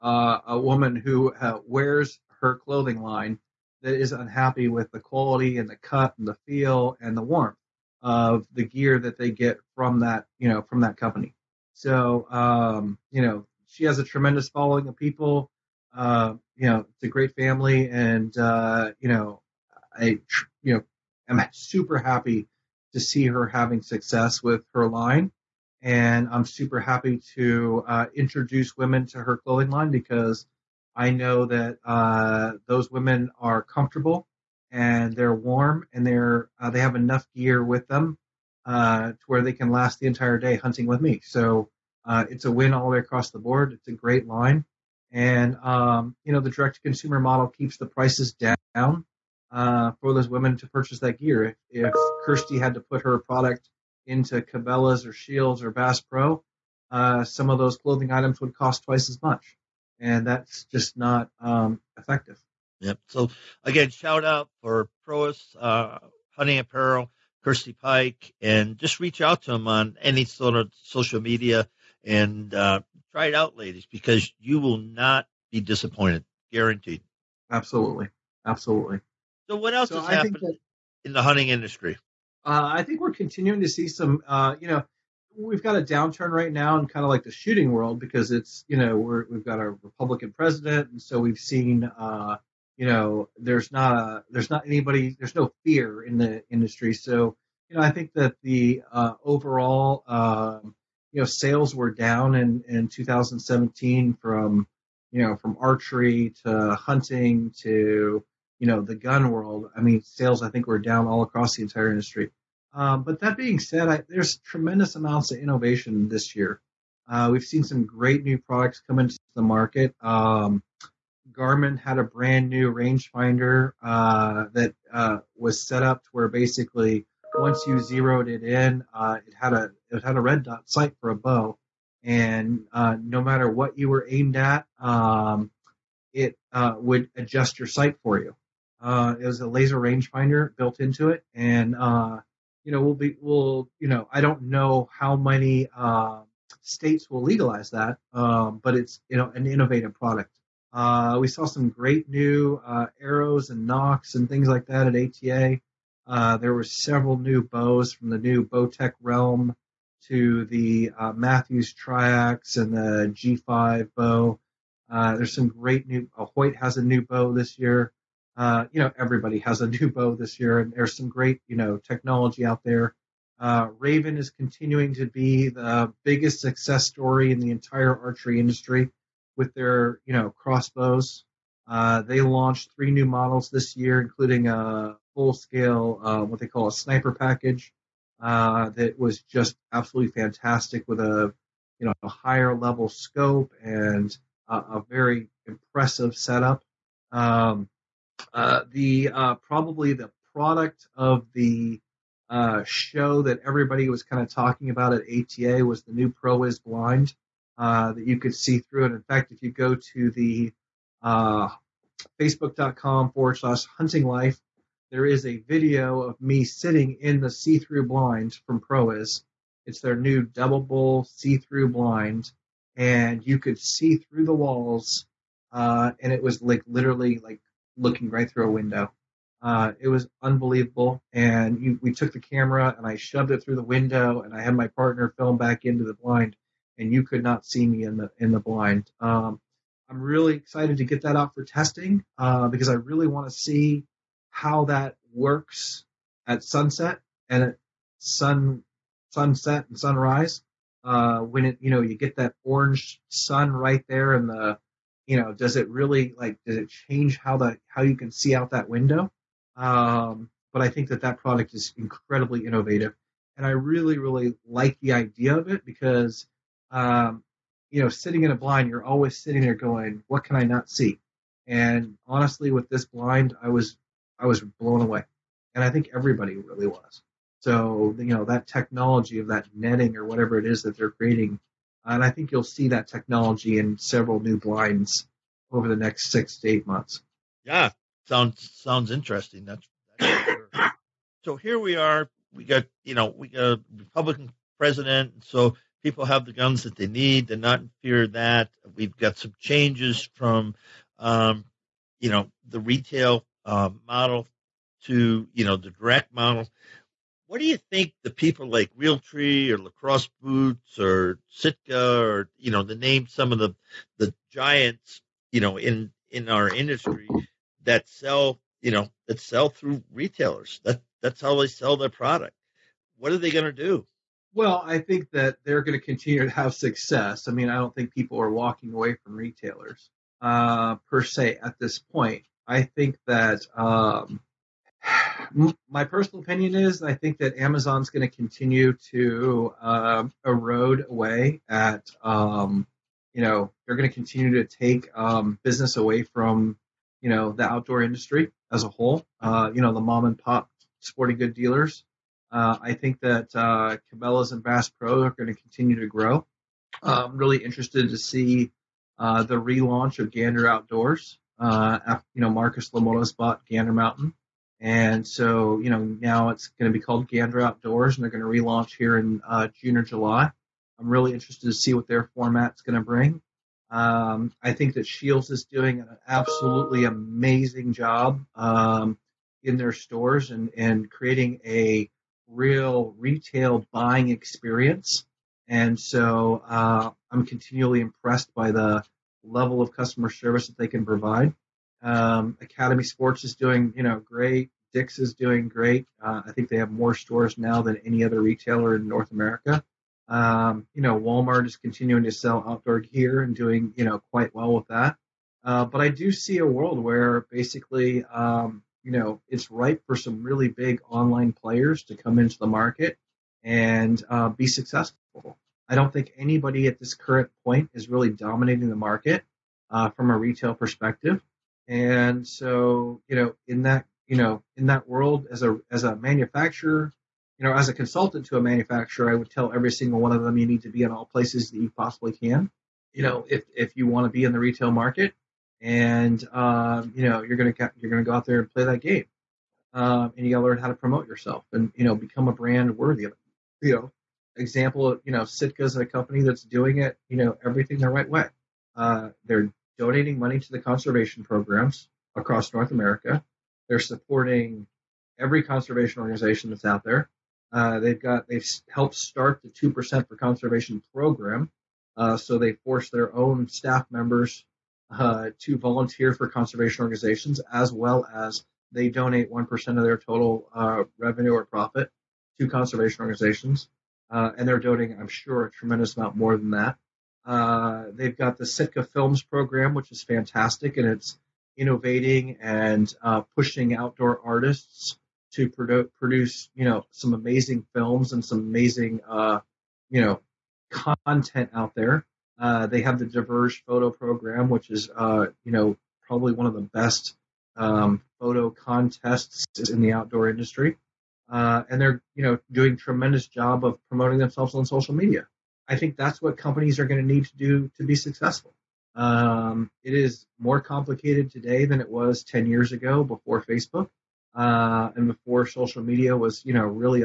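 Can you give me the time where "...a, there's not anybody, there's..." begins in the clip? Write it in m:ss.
1:33.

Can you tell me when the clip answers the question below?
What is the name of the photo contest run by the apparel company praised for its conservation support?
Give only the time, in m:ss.
8:13.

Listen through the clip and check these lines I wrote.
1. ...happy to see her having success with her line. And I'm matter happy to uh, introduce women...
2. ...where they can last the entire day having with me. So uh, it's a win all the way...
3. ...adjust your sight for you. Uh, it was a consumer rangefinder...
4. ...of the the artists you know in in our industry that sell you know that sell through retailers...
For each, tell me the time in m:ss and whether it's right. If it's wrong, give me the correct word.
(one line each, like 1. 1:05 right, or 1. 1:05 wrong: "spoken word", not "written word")
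1. 0:21 wrong: "super", not "matter"
2. 0:39 wrong: "hunting", not "having"
3. 2:17 wrong: "laser", not "consumer"
4. 5:13 wrong: "giants", not "artists".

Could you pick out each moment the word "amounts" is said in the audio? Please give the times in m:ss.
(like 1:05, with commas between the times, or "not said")
1:54, 7:55.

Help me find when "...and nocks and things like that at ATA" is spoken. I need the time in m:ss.
2:33.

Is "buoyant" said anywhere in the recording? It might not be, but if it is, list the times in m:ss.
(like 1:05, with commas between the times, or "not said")
not said.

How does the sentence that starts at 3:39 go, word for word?
It's their new double see through blind.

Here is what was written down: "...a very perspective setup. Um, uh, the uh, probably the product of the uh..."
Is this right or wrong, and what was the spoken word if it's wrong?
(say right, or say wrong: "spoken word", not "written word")
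wrong: "impressive", not "perspective".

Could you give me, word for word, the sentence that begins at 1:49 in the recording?
I mean, sales I think were down all across the entire industry.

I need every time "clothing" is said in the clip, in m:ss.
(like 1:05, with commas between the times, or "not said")
0:02, 0:29, 0:57.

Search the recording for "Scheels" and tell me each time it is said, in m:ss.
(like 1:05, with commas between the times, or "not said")
0:55, 6:14.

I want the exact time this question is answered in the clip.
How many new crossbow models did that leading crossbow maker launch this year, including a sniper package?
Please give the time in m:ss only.
3:02.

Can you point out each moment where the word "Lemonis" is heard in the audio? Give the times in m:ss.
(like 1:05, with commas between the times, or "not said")
6:02.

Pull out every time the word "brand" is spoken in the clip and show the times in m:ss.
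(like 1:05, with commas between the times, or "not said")
2:02, 7:22.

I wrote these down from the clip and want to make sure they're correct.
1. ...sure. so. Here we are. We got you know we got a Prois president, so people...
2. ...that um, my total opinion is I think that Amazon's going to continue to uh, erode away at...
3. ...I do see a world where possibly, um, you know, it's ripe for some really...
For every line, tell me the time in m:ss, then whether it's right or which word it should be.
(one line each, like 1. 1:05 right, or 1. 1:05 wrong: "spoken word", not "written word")
1. 4:50 wrong: "Republican", not "Prois"
2. 5:33 wrong: "personal", not "total"
3. 6:45 wrong: "basically", not "possibly".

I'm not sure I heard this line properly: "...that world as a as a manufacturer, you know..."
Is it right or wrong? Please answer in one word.
right.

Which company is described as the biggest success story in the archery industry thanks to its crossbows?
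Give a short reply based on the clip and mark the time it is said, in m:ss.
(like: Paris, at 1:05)
Ravin, at 2:53.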